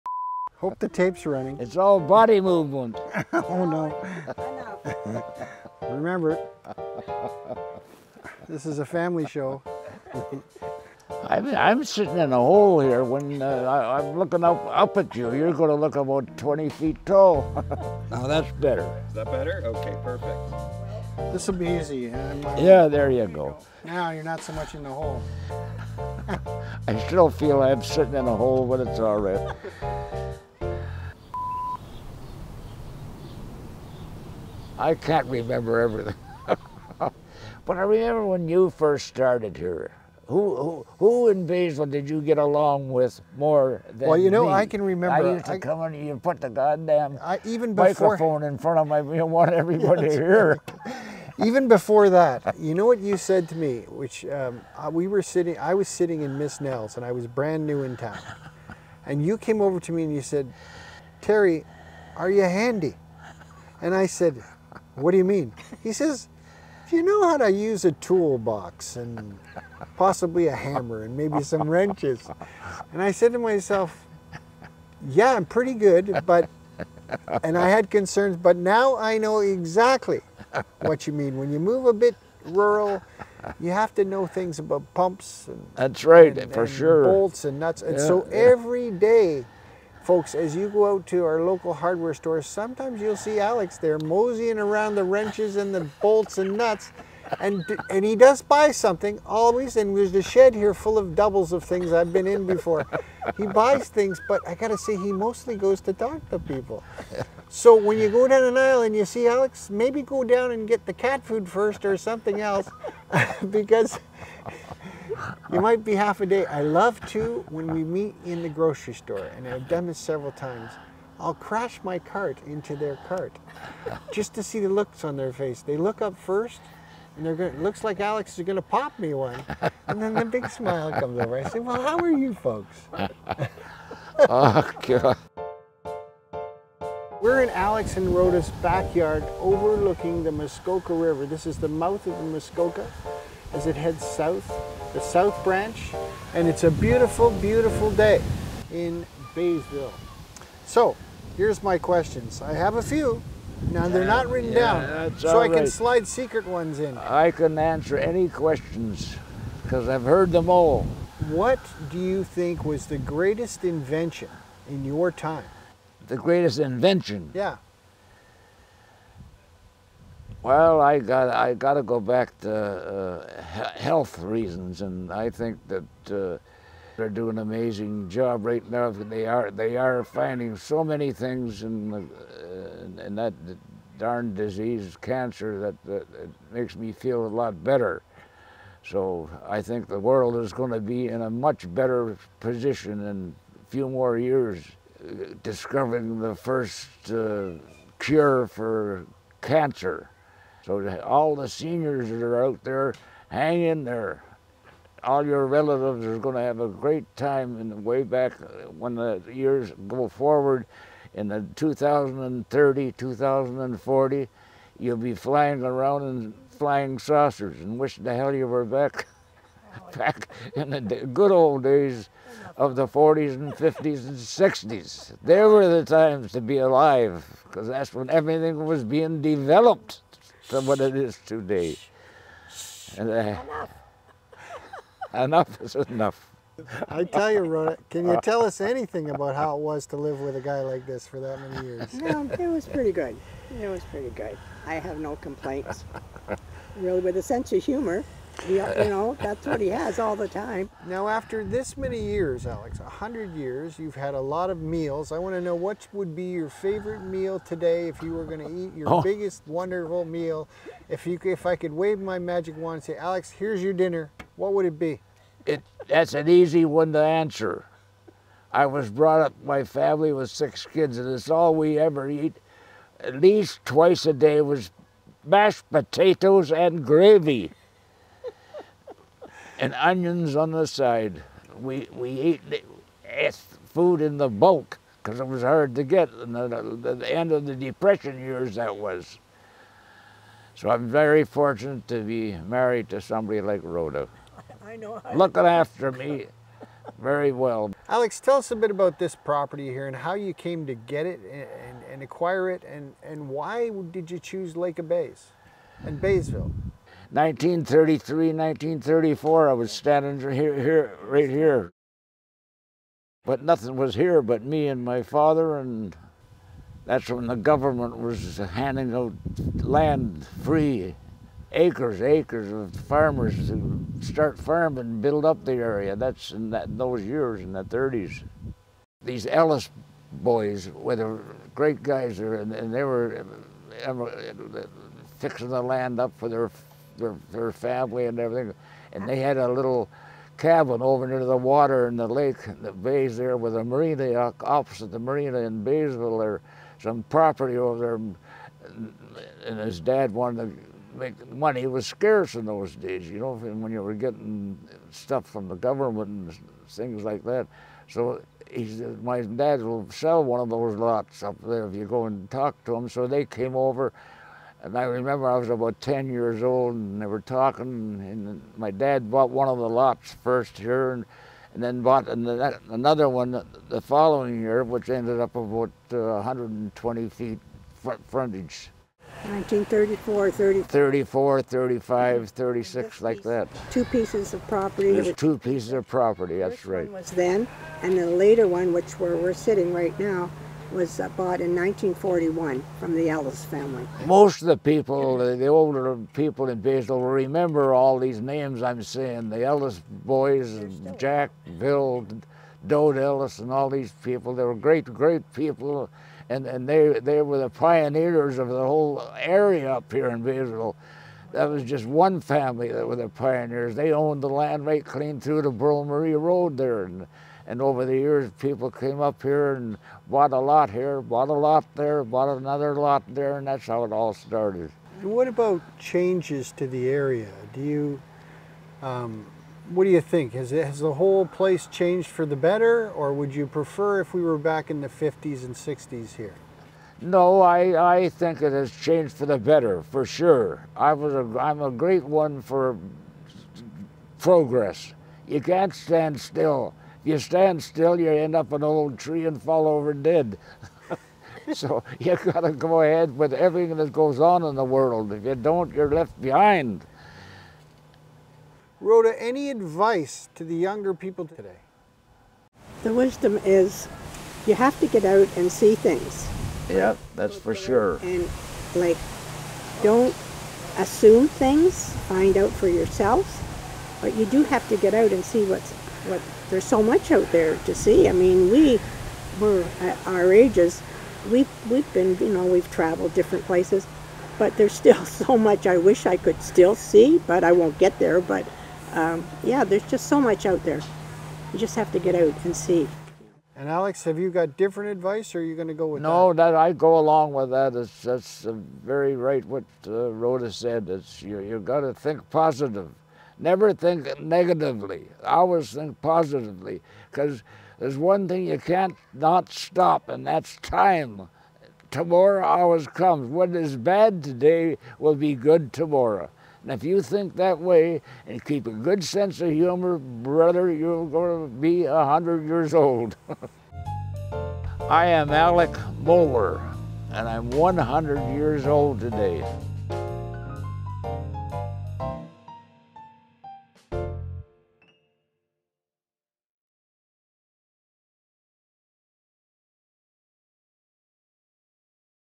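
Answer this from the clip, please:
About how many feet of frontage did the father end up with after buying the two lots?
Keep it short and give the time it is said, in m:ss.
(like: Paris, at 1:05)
120 feet, at 6:15.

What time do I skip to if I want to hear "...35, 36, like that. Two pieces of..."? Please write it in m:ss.
6:21.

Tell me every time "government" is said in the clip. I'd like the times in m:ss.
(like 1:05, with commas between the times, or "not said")
5:17, 5:55.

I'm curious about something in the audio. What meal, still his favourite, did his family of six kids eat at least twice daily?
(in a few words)
mashed potatoes and gravy.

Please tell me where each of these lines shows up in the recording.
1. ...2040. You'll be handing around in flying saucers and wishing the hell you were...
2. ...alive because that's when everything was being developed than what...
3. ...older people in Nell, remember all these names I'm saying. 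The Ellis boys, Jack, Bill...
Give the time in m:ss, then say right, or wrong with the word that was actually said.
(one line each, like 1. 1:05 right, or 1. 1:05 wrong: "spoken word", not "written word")
1. 3:32 wrong: "flying", not "handing"
2. 3:46 right
3. 6:35 wrong: "Baysville", not "Nell".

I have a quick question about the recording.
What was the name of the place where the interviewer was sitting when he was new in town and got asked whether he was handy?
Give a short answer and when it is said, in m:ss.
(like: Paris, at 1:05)
Miss Nell's, at 0:56.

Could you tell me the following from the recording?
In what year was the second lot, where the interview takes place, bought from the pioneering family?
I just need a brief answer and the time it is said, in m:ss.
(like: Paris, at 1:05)
1941, at 6:31.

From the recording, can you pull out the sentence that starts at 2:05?
They look up first, and they're going, looks like Alex is going to pop me one.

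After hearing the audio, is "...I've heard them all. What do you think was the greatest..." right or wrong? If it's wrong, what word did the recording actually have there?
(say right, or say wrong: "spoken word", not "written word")
right.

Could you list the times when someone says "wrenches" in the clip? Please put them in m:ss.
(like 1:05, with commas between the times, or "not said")
1:11, 1:35.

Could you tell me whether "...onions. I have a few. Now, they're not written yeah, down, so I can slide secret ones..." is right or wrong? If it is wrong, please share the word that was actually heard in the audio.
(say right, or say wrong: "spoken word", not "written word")
wrong: "questions", not "onions".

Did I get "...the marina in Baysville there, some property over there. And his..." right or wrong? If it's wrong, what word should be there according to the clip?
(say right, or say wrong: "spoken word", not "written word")
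right.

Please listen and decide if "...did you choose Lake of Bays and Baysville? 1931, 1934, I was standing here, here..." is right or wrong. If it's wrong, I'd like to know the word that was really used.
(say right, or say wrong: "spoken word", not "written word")
wrong: "1933", not "1931".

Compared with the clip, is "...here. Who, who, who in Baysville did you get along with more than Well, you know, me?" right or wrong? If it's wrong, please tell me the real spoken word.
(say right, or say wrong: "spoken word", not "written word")
right.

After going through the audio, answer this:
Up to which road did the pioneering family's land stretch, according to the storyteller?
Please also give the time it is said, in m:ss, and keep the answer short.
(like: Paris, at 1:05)
Burl Marie Road, at 6:55.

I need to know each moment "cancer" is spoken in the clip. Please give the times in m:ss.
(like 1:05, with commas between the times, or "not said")
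3:04, 3:19.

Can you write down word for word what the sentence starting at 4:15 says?
I want to know what would be your favorite meal today if you were going to eat your oh.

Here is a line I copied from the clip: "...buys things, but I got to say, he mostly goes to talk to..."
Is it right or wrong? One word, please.
right.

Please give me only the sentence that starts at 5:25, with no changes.
That's in that, those years, in the 30s.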